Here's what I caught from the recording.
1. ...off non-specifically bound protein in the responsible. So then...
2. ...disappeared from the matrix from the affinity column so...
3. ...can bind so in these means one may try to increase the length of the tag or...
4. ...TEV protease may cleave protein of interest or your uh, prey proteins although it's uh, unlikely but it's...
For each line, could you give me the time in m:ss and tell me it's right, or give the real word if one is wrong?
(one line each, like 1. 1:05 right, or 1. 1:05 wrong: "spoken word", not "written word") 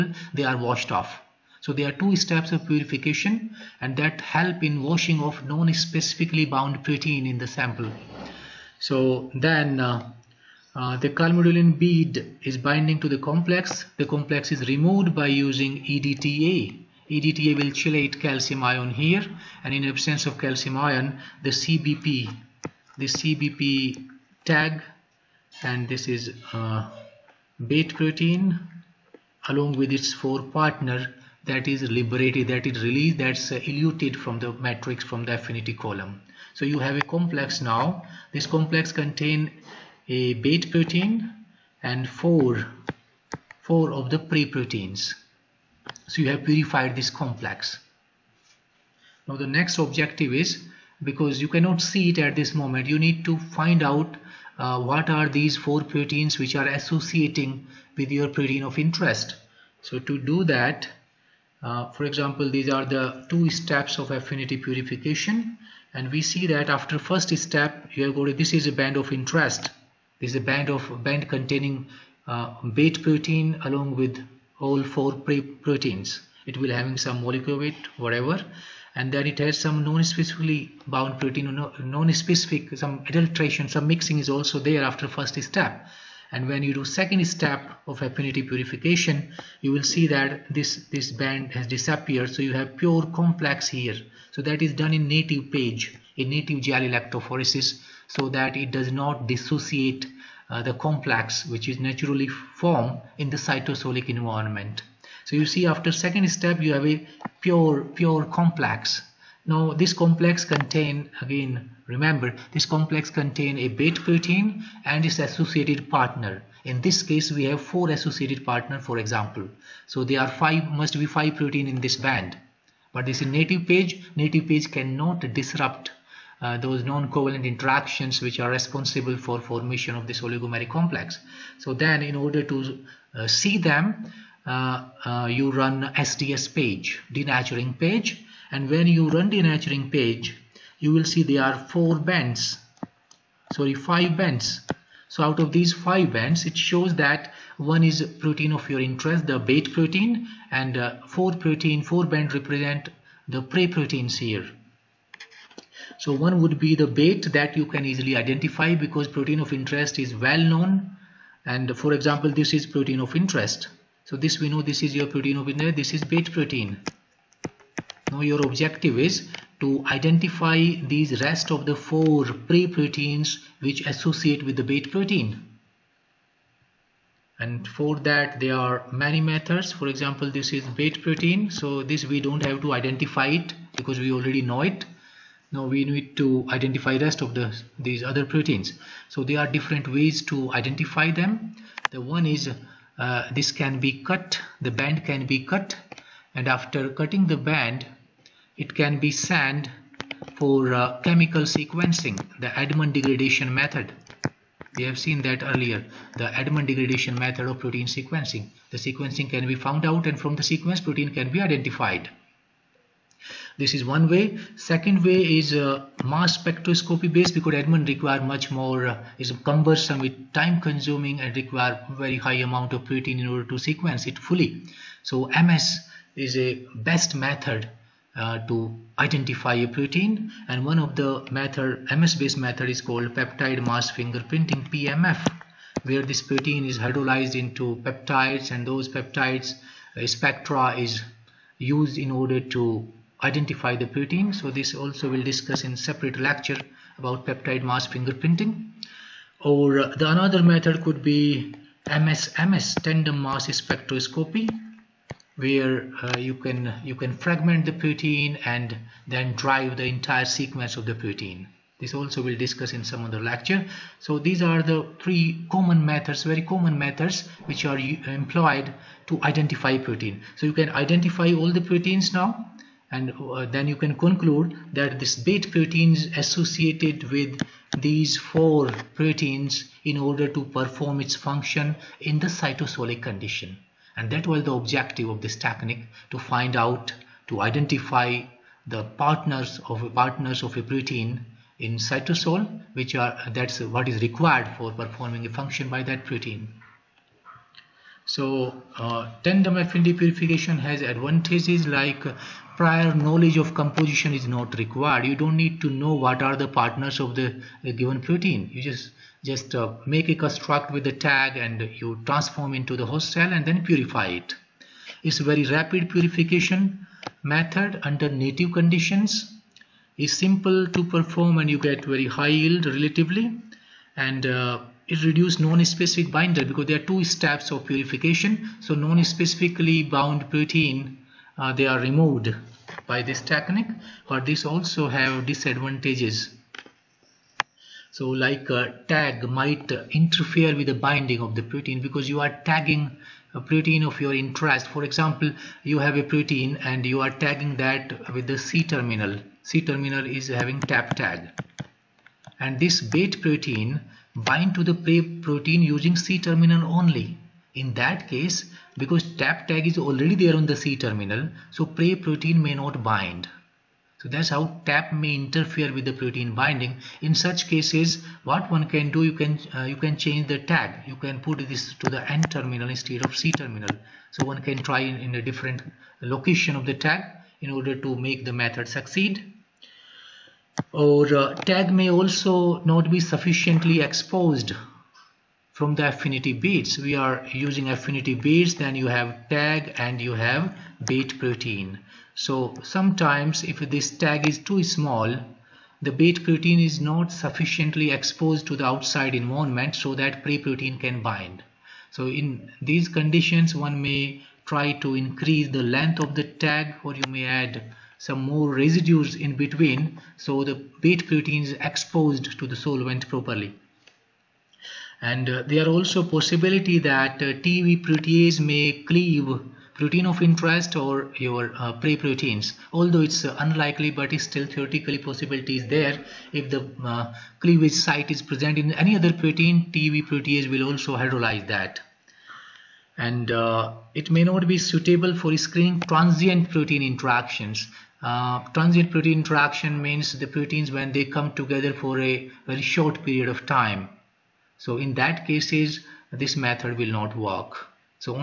1. 0:05 wrong: "sample", not "responsible"
2. 0:33 wrong: "eluted", not "disappeared"
3. 6:40 wrong: "conditions", not "means"
4. 6:57 right.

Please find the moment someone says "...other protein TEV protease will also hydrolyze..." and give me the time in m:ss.
7:08.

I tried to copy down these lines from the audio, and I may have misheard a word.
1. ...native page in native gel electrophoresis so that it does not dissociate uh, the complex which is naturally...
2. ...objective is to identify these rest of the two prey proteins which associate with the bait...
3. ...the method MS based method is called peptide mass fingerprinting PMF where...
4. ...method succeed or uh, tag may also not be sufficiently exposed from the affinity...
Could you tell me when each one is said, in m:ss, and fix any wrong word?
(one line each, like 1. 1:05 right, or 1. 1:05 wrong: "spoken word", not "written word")
1. 1:35 right
2. 2:48 wrong: "four", not "two"
3. 3:50 right
4. 6:18 right.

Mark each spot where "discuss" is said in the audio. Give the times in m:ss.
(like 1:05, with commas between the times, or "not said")
4:05, 4:22.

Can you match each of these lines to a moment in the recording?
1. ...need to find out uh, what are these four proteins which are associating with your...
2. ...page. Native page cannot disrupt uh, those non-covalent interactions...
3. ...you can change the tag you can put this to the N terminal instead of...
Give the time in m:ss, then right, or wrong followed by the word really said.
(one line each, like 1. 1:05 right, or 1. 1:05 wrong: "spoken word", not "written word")
1. 0:52 right
2. 2:03 right
3. 6:09 right.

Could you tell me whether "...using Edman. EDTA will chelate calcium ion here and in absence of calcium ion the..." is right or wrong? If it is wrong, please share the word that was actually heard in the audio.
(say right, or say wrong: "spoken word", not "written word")
wrong: "EDTA", not "Edman".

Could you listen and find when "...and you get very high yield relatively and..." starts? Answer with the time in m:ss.
5:21.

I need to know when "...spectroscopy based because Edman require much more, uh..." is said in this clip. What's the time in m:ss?
3:36.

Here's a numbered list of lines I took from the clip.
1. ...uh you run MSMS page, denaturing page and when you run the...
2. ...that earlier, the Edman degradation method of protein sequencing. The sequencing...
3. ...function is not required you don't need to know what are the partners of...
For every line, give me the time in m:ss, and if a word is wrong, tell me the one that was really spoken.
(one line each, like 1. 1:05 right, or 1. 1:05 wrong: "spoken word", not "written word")
1. 2:15 wrong: "SDS", not "MSMS"
2. 3:25 right
3. 5:03 wrong: "composition", not "function".